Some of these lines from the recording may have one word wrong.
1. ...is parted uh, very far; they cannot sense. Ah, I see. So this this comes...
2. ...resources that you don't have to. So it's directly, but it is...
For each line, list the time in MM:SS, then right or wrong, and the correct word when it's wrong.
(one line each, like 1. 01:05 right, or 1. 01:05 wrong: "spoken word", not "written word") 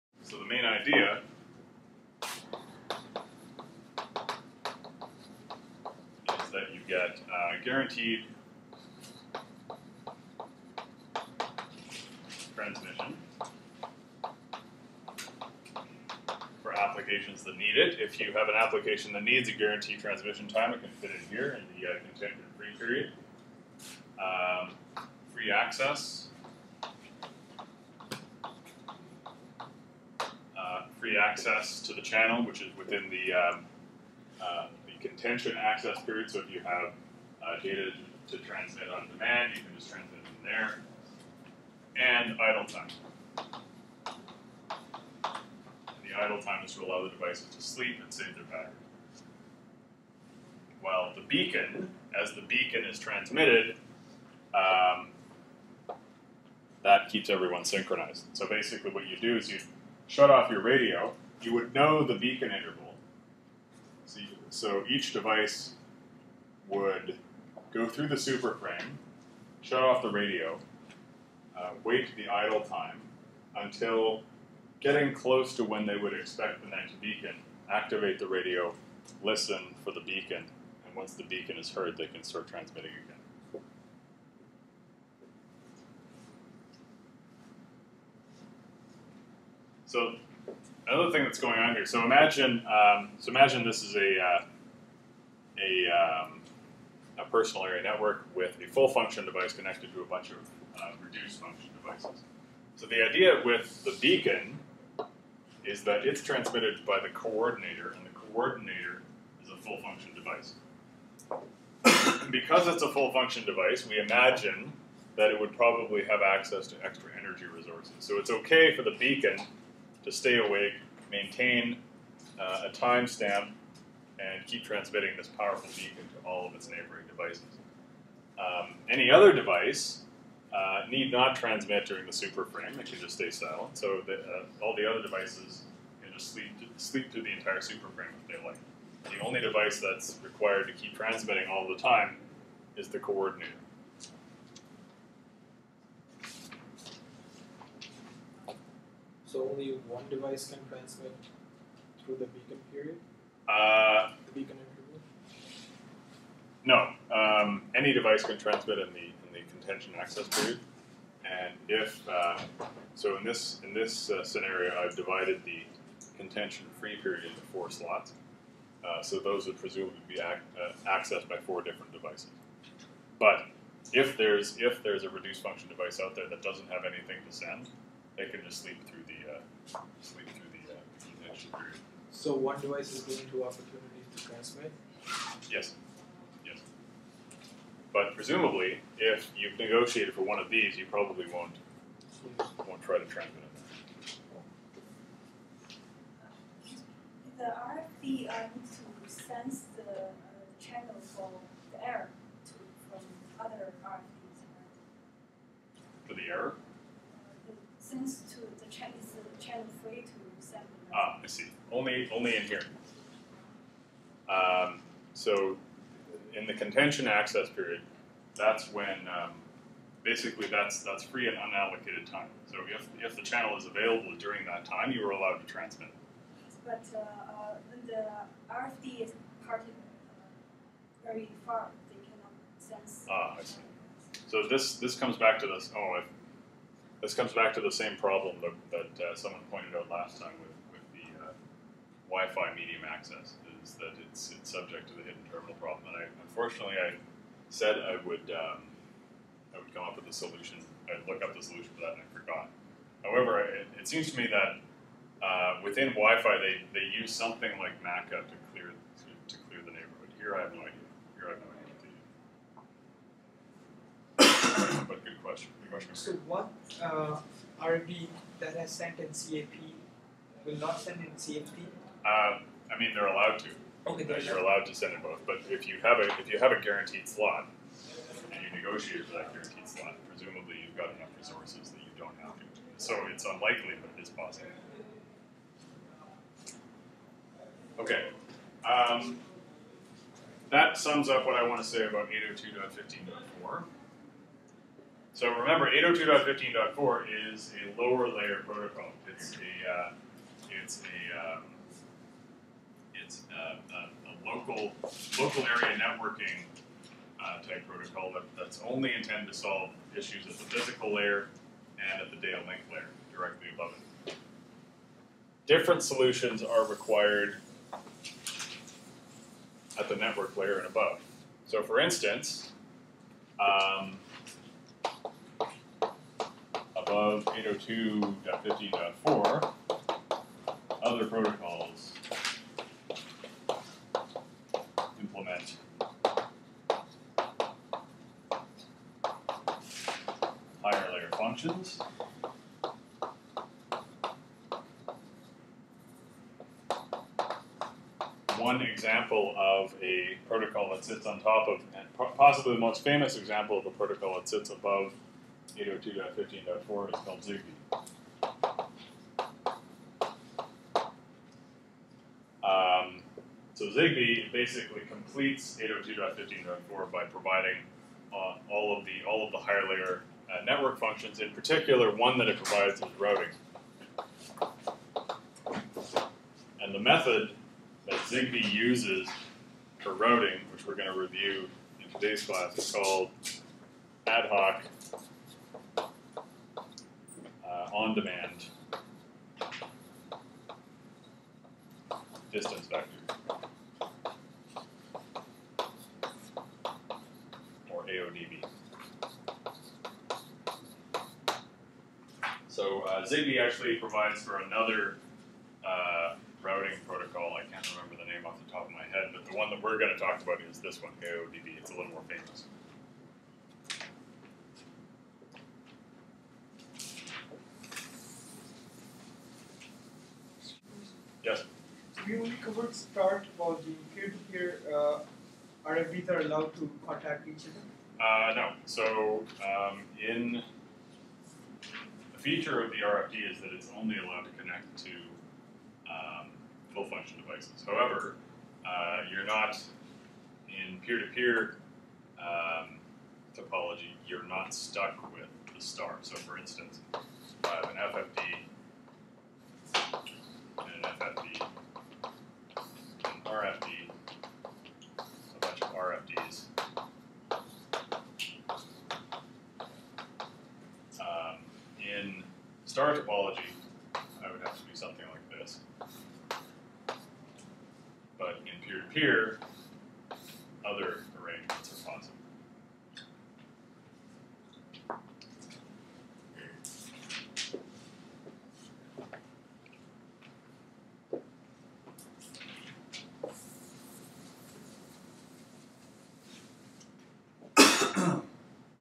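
1. 03:49 right
2. 04:41 wrong: "unlikely", not "directly".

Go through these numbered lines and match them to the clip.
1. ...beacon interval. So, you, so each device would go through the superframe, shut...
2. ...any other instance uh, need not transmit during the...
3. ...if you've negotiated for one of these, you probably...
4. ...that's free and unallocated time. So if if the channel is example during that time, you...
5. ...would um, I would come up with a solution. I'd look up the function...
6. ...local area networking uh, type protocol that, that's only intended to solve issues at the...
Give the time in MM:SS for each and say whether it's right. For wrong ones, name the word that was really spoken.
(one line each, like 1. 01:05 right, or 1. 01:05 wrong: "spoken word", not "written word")
1. 01:02 right
2. 02:08 wrong: "device", not "instance"
3. 03:08 right
4. 03:40 wrong: "available", not "example"
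5. 04:08 wrong: "solution", not "function"
6. 05:05 right.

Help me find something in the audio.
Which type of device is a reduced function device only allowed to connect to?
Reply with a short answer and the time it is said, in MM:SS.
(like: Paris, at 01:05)
Full function devices, at 07:16.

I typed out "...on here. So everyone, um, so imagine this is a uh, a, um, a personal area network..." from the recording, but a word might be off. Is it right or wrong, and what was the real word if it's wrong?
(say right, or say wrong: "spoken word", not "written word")
wrong: "imagine", not "everyone".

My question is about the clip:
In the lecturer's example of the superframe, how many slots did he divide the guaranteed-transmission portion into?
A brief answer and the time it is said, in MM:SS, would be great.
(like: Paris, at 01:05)
4, at 02:47.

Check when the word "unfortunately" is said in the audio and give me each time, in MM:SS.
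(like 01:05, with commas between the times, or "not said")
04:06.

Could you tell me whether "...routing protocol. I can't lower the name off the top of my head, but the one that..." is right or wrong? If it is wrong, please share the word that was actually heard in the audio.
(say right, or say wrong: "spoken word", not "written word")
wrong: "remember", not "lower".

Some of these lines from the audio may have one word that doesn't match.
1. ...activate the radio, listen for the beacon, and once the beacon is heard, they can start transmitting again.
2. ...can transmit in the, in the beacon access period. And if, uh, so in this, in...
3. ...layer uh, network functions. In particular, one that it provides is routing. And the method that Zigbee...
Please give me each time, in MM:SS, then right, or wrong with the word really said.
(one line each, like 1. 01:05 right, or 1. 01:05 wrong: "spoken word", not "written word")
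1. 01:17 right
2. 02:38 wrong: "contention", not "beacon"
3. 06:09 right.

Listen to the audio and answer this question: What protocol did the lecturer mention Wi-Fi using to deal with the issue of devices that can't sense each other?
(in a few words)
MACA.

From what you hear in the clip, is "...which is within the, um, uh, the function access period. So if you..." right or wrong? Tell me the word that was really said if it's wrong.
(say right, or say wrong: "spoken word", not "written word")
wrong: "contention", not "function".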